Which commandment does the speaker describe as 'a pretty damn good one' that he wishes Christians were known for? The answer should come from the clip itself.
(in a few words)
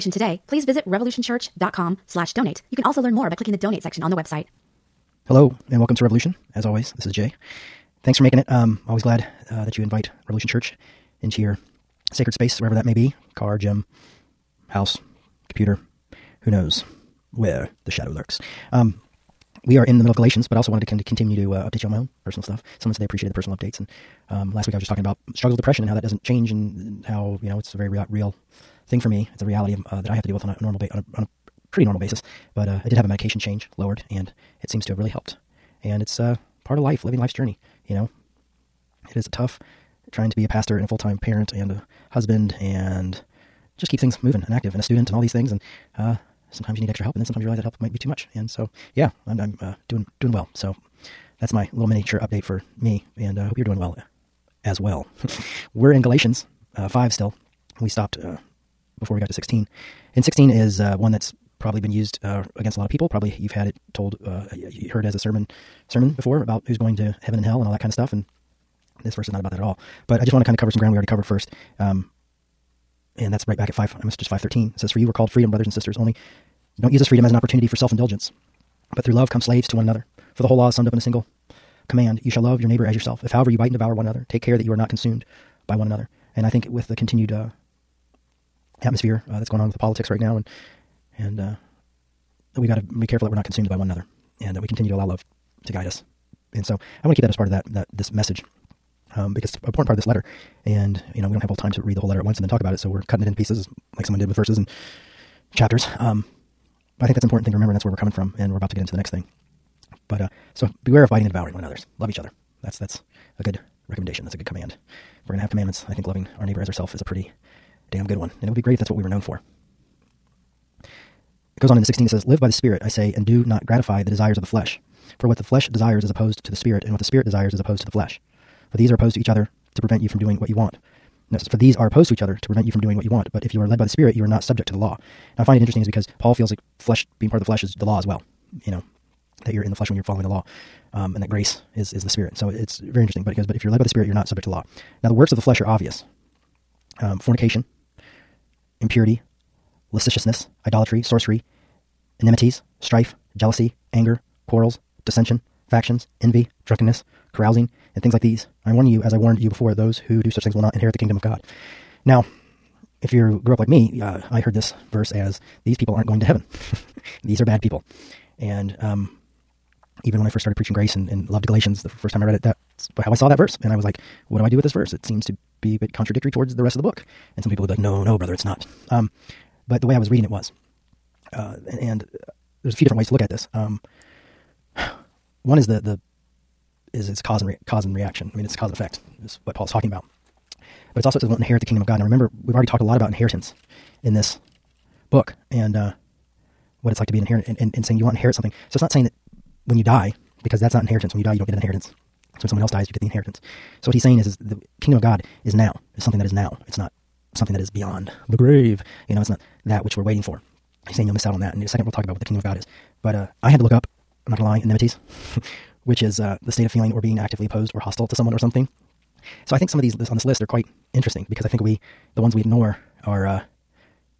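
Loving our neighbor.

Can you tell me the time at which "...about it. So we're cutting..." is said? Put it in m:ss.
1:42.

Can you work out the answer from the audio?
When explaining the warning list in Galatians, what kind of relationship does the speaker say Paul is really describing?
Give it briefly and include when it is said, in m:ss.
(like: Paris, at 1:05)
Cause and effect, at 3:08.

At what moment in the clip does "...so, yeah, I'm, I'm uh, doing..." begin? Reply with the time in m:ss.
0:48.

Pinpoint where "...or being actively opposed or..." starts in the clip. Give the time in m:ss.
3:36.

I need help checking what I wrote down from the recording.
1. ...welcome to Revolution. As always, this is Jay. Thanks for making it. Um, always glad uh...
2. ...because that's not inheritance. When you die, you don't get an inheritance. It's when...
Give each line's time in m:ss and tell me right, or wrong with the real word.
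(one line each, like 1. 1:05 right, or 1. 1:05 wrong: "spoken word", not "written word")
1. 0:05 right
2. 3:20 right.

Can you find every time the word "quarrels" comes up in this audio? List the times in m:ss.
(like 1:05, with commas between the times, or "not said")
2:34.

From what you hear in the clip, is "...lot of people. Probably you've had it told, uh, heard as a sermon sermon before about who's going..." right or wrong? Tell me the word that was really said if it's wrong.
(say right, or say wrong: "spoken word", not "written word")
right.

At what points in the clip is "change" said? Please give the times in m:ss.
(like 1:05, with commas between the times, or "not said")
0:26, 0:33.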